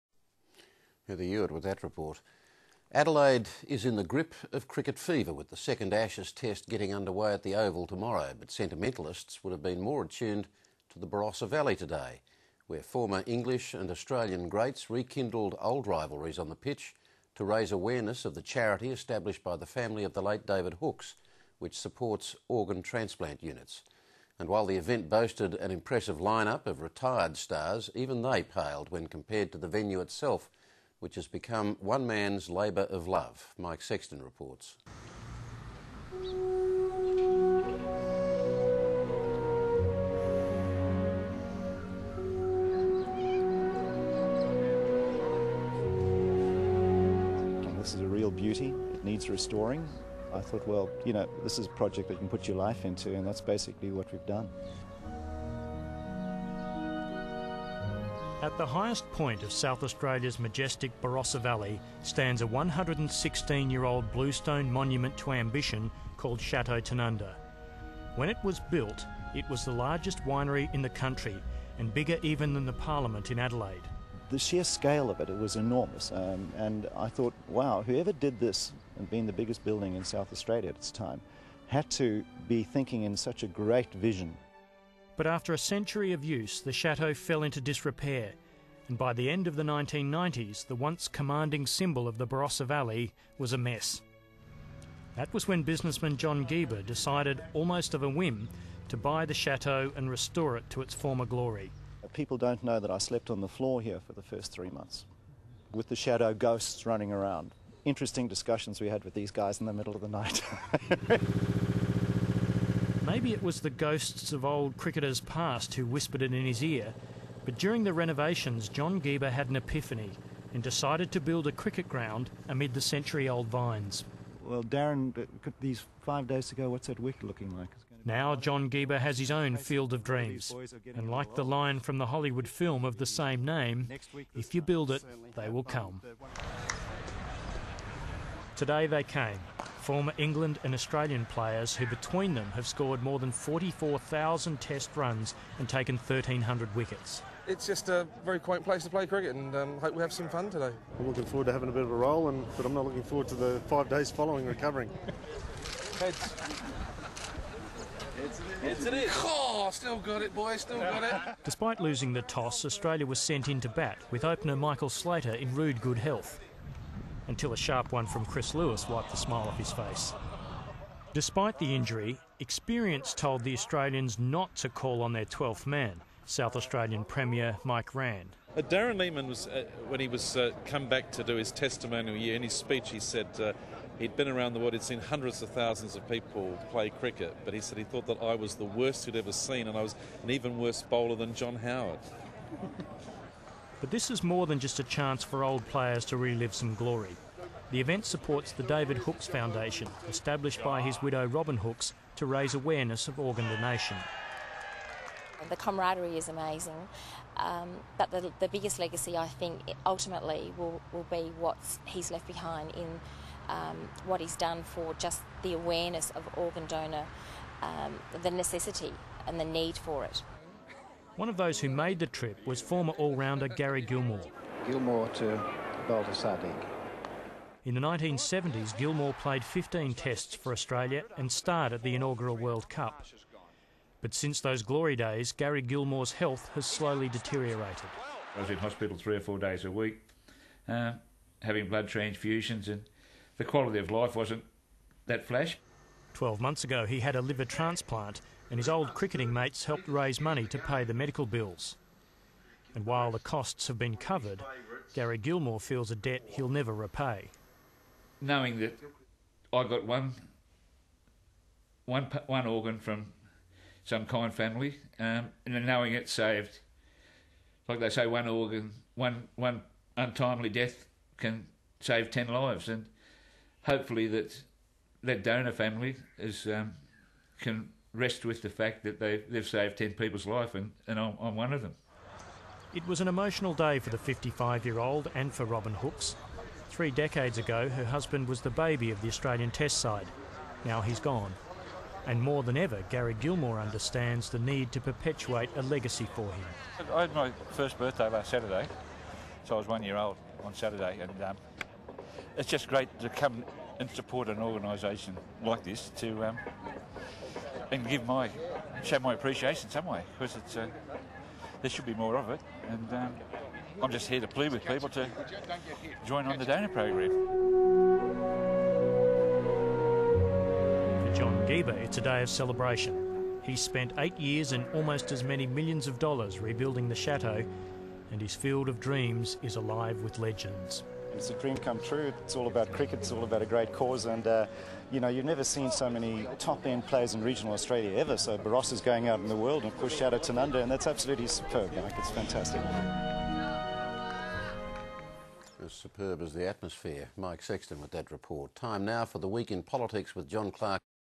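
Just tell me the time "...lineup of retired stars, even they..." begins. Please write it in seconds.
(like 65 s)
26 s.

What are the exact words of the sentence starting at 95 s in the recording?
That was when businessman John Geber decided, almost of a whim, to buy the chateau and restore it to its former glory.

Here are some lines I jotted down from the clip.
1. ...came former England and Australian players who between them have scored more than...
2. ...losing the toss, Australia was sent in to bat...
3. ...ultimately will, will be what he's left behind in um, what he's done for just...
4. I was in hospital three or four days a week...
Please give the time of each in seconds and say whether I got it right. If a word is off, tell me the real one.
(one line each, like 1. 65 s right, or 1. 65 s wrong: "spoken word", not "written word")
1. 139 s right
2. 161 s right
3. 209 s right
4. 238 s right.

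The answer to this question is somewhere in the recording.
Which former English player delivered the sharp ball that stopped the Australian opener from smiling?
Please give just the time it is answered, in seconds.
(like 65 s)
168 s.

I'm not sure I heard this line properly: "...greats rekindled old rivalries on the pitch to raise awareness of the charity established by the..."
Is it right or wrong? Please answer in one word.
right.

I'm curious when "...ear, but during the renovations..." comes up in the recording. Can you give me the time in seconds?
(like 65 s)
116 s.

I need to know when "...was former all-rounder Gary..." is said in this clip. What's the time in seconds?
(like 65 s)
222 s.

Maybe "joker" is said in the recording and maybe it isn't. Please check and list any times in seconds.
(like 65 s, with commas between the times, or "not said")
not said.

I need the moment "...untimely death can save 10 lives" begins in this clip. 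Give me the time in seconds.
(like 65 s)
269 s.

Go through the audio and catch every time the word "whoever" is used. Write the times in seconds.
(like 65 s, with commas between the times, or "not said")
77 s.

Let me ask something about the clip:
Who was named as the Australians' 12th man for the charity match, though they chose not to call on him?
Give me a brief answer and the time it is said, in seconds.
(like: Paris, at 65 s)
Mike Rann, at 177 s.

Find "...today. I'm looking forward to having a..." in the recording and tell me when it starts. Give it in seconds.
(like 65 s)
150 s.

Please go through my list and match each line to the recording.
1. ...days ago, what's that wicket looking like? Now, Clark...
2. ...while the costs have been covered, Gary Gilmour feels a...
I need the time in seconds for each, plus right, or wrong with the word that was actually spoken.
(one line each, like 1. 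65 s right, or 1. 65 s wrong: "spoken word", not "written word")
1. 126 s wrong: "John", not "Clark"
2. 252 s right.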